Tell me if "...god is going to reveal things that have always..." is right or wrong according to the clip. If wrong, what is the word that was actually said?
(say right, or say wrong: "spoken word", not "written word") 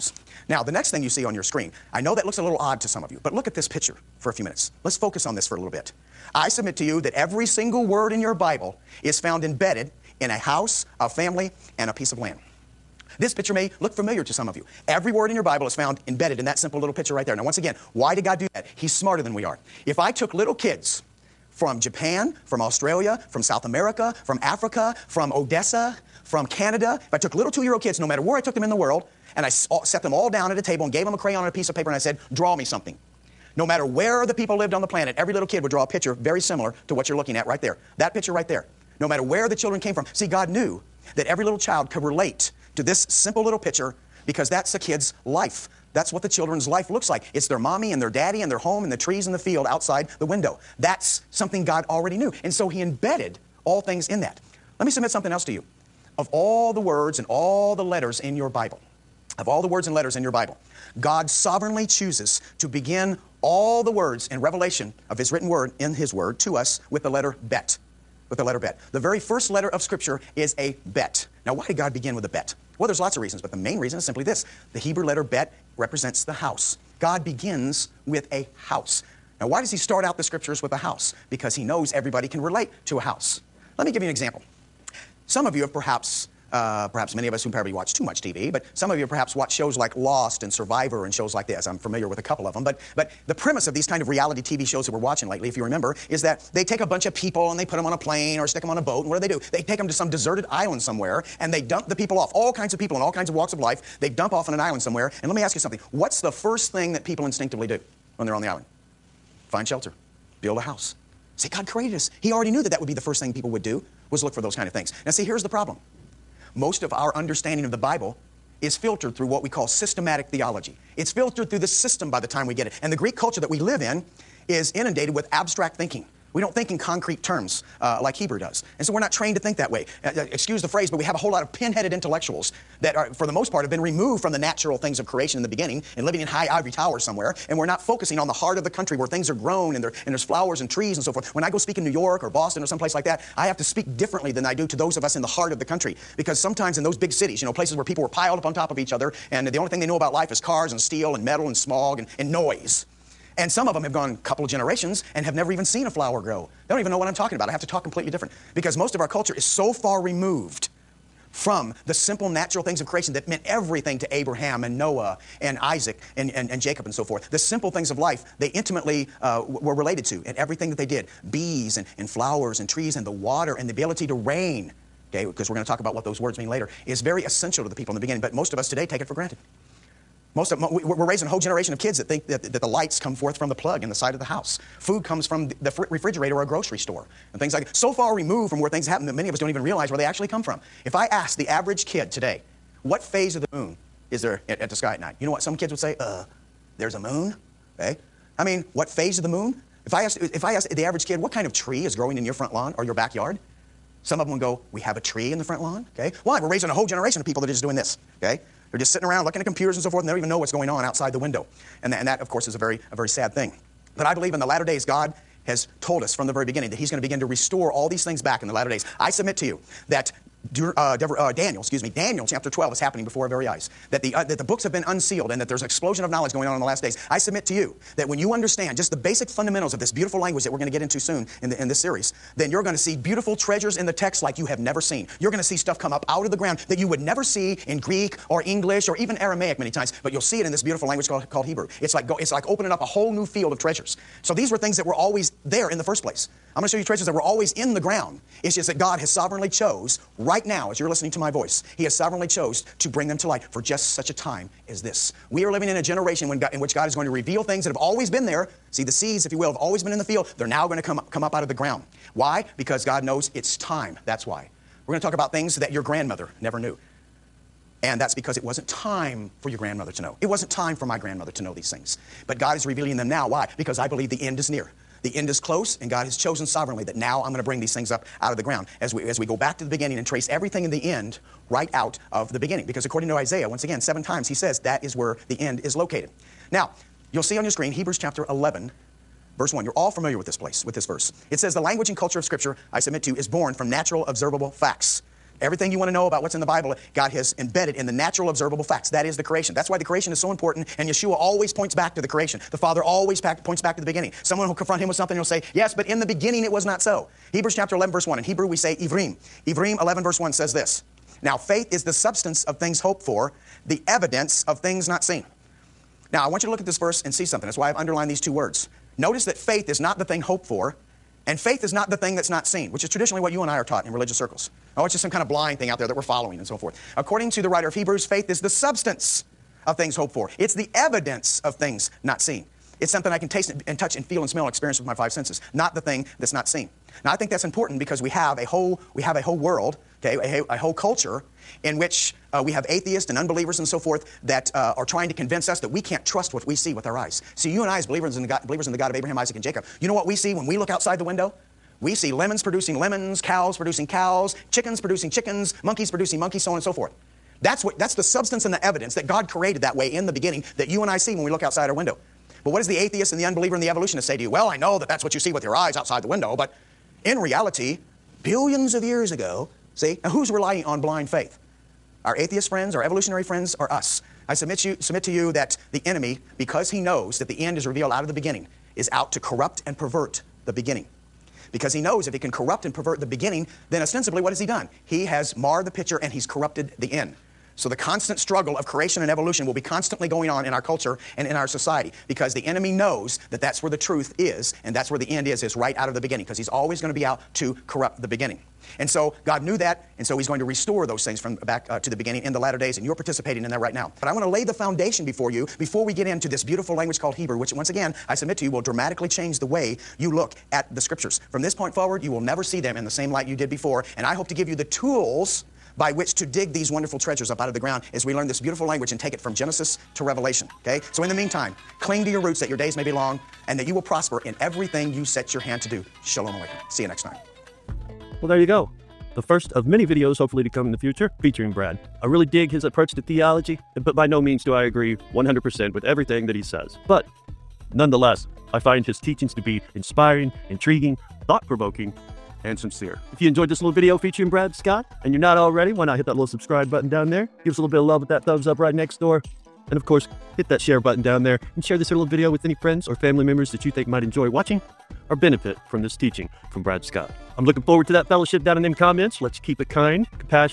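right.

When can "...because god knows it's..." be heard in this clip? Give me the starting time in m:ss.
4:22.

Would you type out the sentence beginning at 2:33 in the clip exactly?
And some of them have gone a couple of generations and have never even seen a flower grow.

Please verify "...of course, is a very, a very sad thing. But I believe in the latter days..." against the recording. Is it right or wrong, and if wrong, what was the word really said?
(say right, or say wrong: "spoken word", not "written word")
right.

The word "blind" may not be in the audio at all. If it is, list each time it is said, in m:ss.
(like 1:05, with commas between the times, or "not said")
5:25, 6:10.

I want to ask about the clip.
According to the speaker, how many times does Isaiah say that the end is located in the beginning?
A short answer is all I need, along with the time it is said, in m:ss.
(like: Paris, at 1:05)
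7, at 4:43.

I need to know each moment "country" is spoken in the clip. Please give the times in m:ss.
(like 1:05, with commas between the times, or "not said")
2:18, 2:25.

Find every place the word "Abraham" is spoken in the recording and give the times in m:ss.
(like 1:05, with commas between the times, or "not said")
2:44, 5:48.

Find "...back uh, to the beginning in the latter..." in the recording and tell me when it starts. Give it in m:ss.
6:41.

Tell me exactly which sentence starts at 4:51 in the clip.
It says, The language and culture of Scripture, I submit to, is born from natural observable facts.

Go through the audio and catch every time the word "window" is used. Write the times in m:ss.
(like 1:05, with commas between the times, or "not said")
0:50, 3:31, 5:51, 6:01, 6:06.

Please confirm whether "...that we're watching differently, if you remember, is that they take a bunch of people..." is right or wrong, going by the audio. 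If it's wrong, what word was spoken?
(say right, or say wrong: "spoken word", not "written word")
wrong: "lately", not "differently".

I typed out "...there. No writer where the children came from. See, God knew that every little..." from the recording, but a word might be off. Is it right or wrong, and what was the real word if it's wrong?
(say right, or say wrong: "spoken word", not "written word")
wrong: "matter", not "writer".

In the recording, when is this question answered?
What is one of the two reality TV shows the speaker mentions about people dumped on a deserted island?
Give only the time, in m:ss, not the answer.
1:29.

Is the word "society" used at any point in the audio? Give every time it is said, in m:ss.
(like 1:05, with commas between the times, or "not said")
6:31.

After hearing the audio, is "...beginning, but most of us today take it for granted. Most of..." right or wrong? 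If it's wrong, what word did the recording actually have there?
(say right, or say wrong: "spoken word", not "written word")
right.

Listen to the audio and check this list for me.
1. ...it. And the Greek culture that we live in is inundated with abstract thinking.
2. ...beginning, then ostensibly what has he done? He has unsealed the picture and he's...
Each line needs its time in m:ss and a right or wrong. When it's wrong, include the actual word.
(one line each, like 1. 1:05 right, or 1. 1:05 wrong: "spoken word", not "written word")
1. 2:02 right
2. 6:23 wrong: "marred", not "unsealed".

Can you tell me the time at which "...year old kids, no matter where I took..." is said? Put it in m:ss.
0:27.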